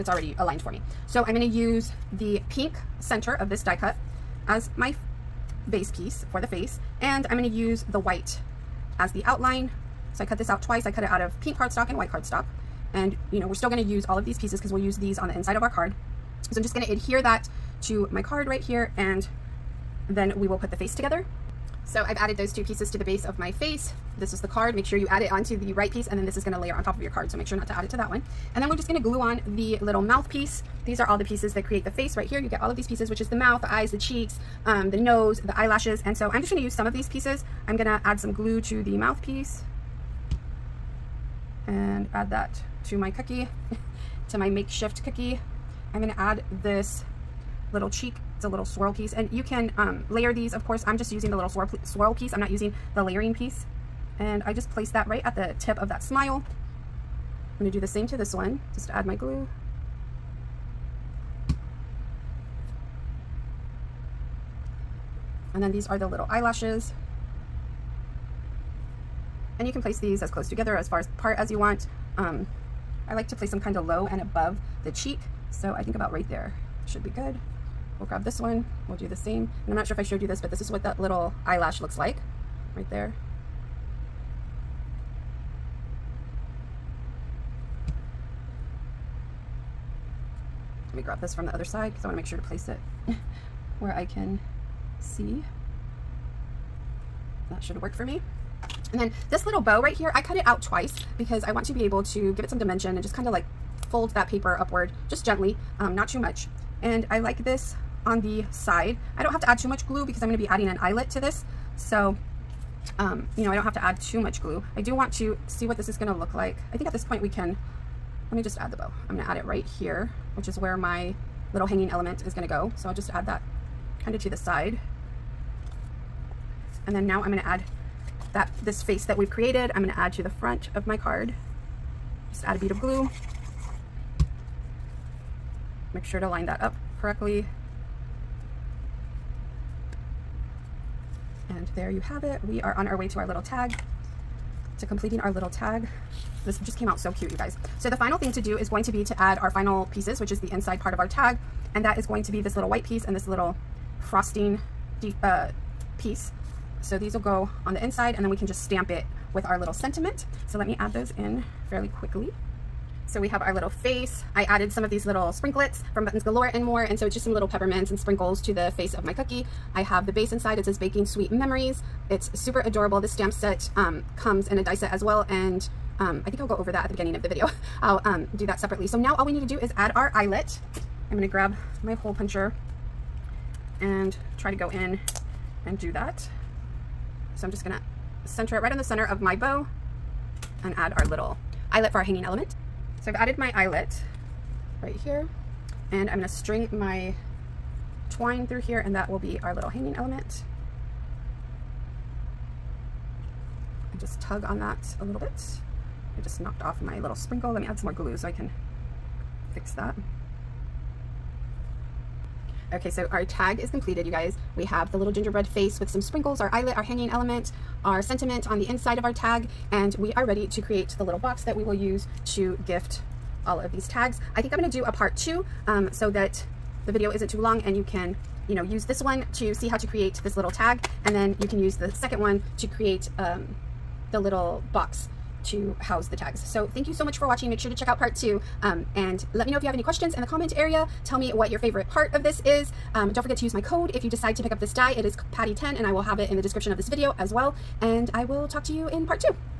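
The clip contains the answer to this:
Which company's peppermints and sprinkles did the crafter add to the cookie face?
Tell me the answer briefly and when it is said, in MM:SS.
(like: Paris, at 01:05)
Buttons Galore and More, at 02:46.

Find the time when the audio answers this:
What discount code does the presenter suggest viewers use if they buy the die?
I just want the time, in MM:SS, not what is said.
04:05.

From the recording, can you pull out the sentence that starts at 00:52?
I'm not using the layering piece and I just placed that right at the tip of that smile.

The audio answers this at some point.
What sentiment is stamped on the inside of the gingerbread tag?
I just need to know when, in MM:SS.
02:50.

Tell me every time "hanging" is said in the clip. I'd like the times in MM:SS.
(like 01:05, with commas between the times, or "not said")
02:01, 03:12, 03:19, 03:36.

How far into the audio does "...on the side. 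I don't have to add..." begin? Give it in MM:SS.
01:48.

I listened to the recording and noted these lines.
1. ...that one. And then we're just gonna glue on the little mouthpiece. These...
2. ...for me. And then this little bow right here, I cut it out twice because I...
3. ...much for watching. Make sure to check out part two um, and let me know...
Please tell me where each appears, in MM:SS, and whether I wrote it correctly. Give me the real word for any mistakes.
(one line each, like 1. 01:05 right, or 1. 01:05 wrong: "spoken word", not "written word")
1. 00:27 right
2. 01:37 right
3. 03:57 right.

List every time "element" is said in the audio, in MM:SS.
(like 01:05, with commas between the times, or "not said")
02:01, 03:12, 03:19, 03:37.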